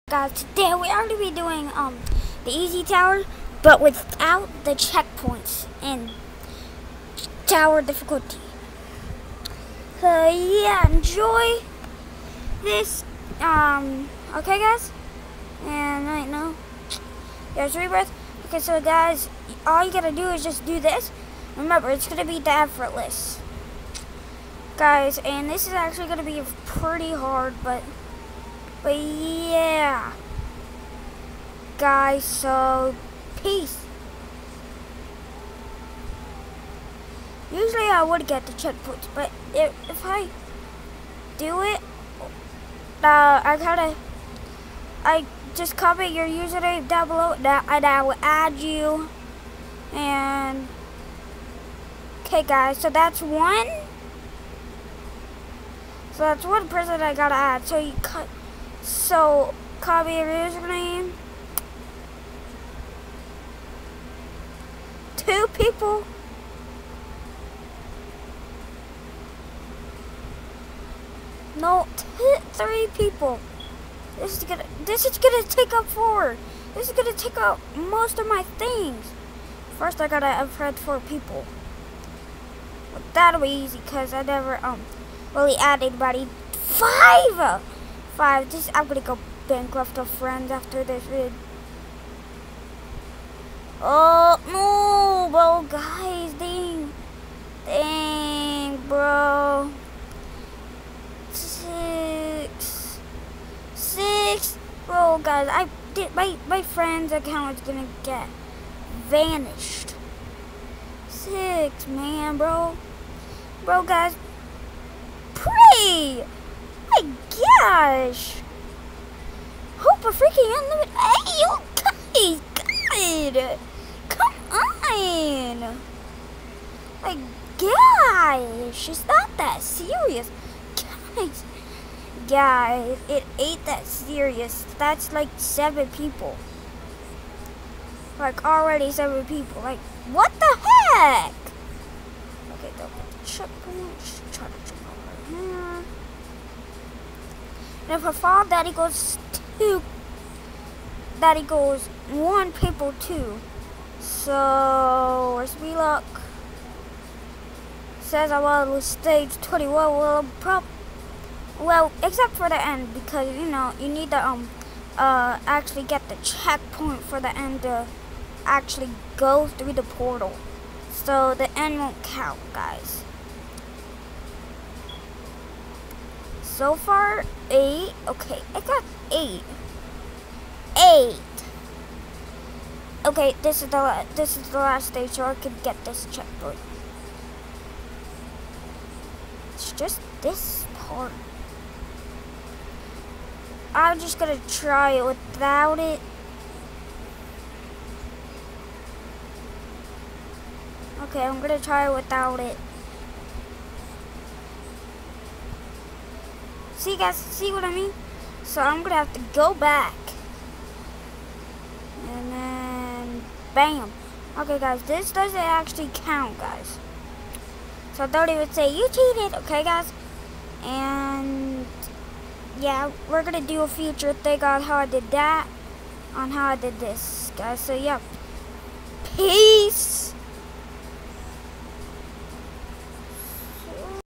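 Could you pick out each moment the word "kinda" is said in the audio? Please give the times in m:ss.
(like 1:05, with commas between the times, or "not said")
0:43.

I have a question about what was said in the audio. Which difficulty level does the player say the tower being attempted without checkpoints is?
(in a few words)
effortless.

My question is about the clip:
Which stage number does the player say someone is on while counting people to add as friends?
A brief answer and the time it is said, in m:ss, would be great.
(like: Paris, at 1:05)
21, at 2:38.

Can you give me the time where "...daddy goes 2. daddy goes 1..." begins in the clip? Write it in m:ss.
2:28.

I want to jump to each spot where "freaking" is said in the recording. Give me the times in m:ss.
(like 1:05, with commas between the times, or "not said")
2:00.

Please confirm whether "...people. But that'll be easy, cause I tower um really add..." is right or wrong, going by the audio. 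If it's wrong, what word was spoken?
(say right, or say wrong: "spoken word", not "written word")
wrong: "never", not "tower".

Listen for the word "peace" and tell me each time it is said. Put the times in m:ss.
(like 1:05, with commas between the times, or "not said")
0:33, 3:49.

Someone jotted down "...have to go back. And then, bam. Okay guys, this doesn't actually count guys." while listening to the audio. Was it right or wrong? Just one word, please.
right.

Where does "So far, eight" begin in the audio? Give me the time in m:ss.
2:56.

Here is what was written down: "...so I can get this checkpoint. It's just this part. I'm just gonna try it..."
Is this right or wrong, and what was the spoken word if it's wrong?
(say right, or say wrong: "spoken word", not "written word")
right.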